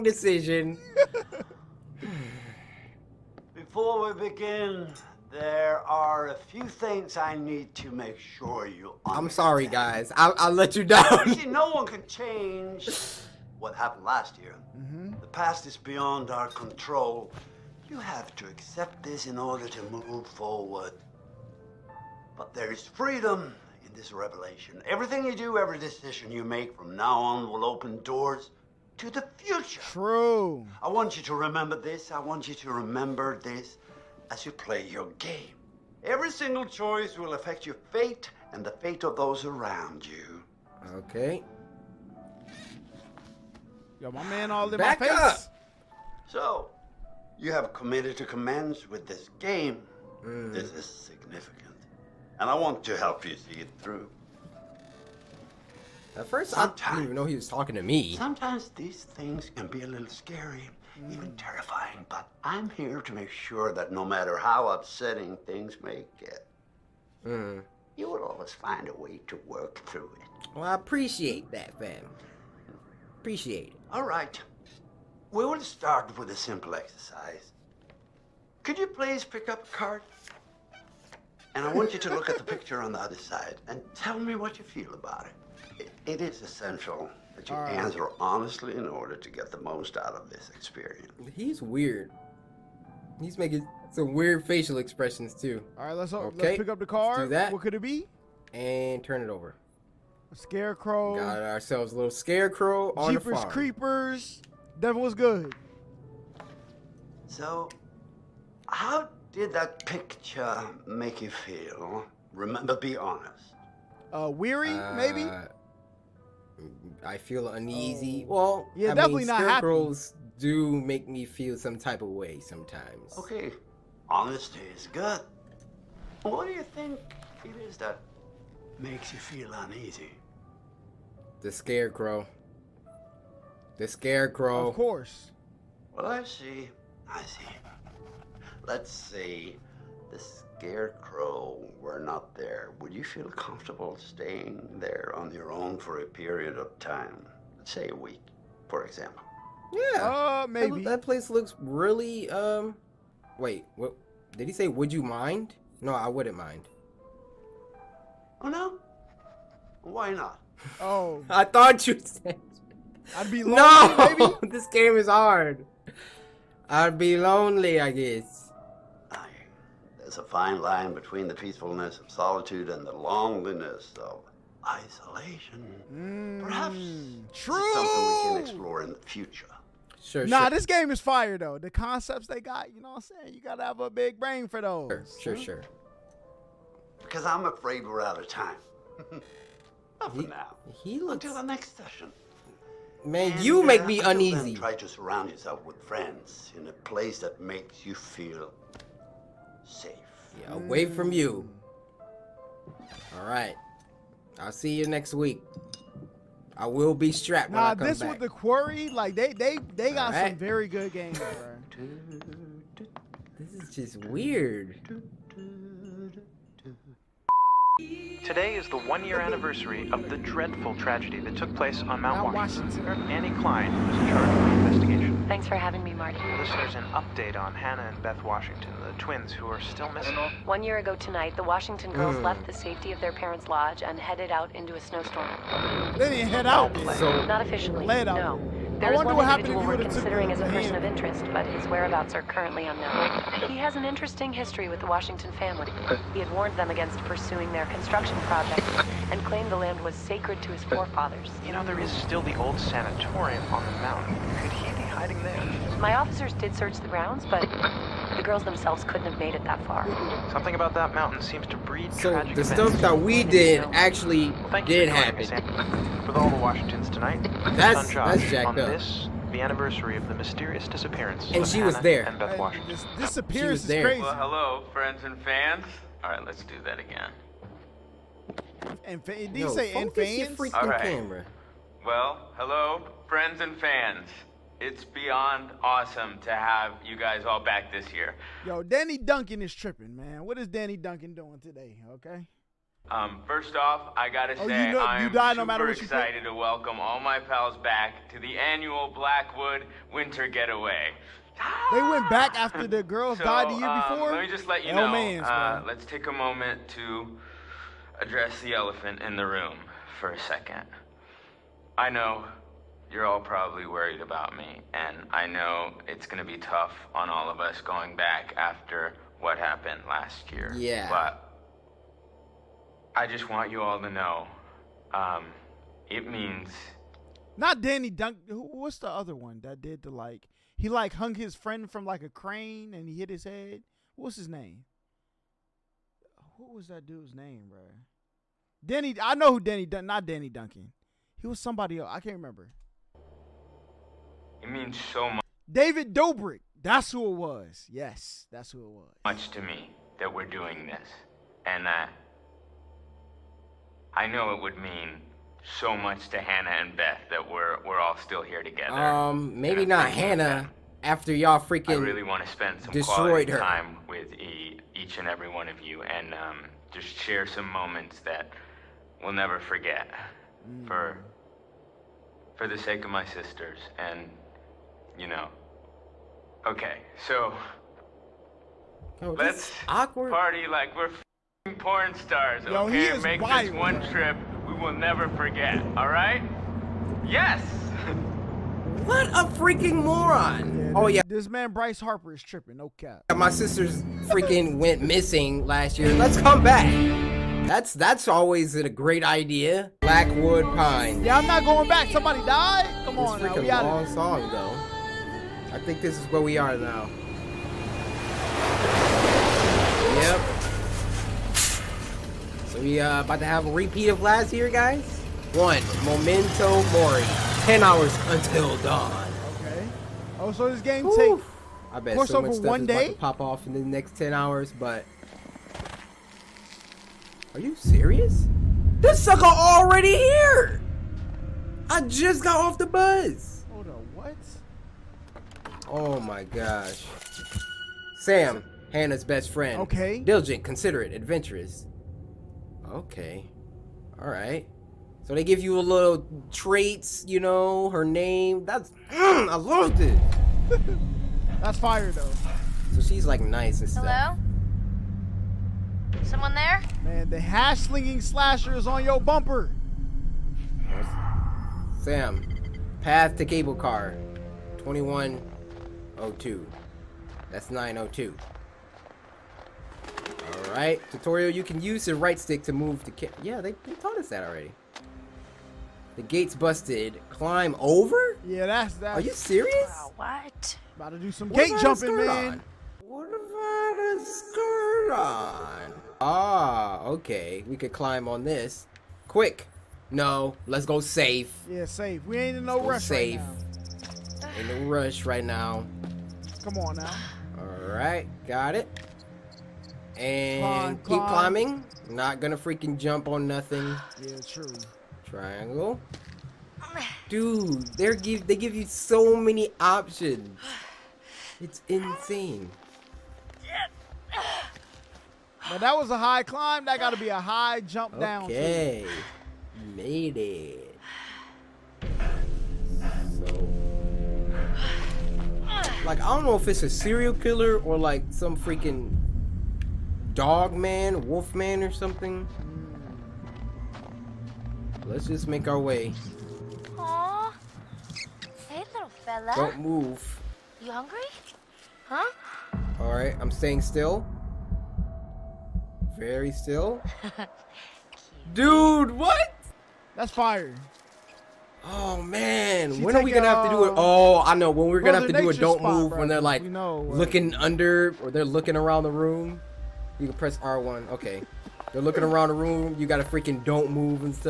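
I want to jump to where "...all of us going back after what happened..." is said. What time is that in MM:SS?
05:17.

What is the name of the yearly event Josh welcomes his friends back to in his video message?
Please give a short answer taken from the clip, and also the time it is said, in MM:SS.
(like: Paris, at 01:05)
Blackwood Winter Getaway, at 04:58.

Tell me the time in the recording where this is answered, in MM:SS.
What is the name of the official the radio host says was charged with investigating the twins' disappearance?
03:43.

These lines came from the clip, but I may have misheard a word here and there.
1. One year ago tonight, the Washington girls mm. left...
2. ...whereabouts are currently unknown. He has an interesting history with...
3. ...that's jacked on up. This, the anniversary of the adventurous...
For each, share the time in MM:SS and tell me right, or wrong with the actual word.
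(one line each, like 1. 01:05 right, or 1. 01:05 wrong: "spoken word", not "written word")
1. 03:50 right
2. 04:01 right
3. 04:28 wrong: "mysterious", not "adventurous".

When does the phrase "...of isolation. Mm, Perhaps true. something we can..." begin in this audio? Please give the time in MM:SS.
02:54.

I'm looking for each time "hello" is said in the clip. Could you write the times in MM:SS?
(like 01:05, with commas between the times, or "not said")
04:34, 04:42, 07:33.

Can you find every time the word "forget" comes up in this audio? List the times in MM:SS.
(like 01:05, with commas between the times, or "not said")
06:09, 06:25.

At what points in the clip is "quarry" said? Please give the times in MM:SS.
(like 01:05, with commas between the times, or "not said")
03:28.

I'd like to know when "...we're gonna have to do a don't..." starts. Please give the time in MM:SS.
09:14.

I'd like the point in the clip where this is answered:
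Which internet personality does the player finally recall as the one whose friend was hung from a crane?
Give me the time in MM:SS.
05:45.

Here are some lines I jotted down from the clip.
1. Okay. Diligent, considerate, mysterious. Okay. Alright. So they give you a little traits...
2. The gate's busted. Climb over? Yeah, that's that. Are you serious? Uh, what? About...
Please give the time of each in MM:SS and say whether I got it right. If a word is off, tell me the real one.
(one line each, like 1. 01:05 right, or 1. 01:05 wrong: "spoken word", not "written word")
1. 07:19 wrong: "adventurous", not "mysterious"
2. 07:55 right.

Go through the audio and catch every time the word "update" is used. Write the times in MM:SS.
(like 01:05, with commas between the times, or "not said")
03:46.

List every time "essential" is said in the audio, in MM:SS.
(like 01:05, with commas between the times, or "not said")
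01:26.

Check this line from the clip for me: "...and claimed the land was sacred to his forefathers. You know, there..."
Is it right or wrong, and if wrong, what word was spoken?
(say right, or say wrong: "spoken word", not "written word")
right.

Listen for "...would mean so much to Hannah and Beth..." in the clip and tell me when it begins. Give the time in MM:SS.
05:54.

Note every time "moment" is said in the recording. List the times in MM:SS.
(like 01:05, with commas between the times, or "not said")
05:06, 06:07.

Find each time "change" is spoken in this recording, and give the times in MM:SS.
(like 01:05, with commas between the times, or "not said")
00:12.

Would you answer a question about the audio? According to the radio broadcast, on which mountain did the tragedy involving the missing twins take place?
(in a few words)
Mount Washington.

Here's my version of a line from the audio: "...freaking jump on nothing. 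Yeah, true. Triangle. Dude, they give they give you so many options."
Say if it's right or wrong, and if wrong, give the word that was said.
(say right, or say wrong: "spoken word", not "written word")
right.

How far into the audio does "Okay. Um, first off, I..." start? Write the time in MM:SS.
04:51.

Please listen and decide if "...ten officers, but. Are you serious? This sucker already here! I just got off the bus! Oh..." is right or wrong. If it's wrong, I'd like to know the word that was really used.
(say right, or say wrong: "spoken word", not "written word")
wrong: "hours", not "officers".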